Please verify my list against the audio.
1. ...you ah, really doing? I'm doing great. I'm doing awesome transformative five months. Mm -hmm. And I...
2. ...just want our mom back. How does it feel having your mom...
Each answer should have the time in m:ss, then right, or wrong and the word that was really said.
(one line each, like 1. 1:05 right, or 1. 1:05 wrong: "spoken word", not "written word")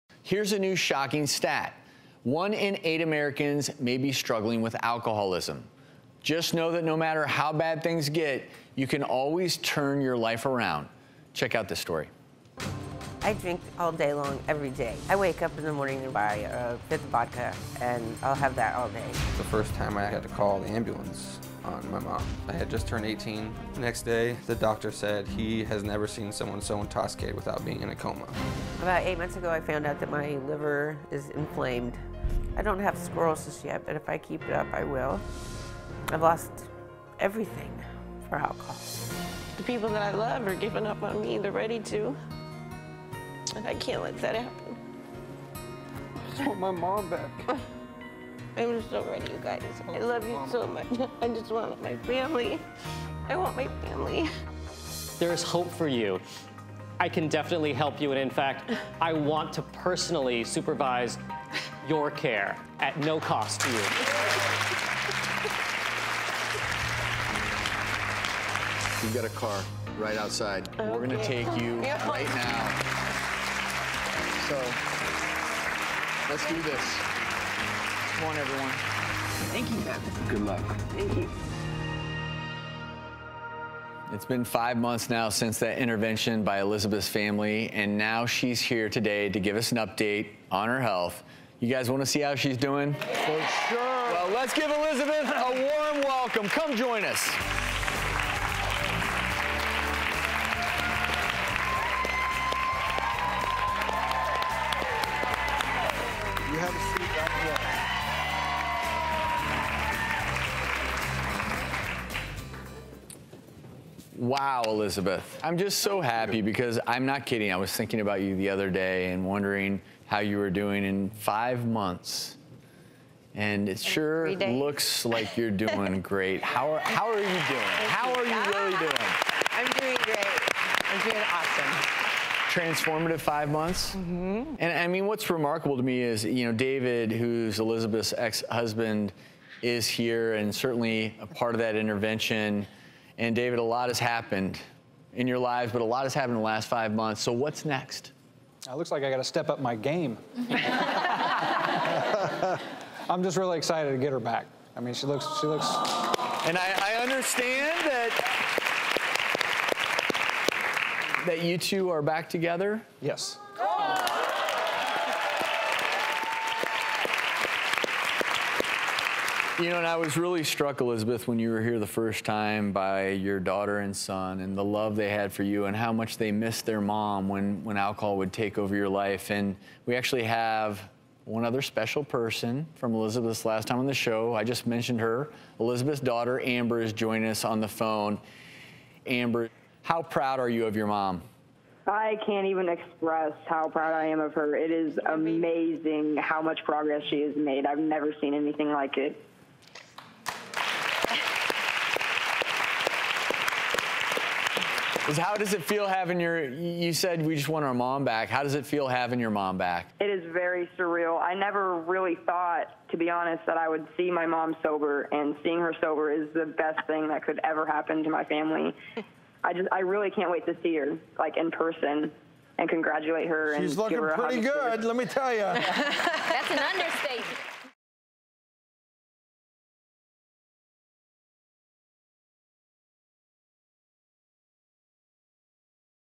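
1. 2:08 right
2. 3:27 right.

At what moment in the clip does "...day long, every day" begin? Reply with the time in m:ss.
0:13.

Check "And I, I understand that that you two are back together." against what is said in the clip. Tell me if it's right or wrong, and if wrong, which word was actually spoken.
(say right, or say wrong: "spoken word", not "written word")
right.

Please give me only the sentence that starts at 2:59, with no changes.
And we actually have one other special person from Elizabeth's last time on the show.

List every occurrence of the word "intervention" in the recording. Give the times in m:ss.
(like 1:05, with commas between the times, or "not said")
1:25, 2:21.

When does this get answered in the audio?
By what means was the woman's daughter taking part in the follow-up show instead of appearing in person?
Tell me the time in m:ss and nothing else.
3:07.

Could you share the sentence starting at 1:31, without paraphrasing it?
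You guys want to see how she's doing?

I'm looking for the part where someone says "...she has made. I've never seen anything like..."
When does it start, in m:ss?
3:17.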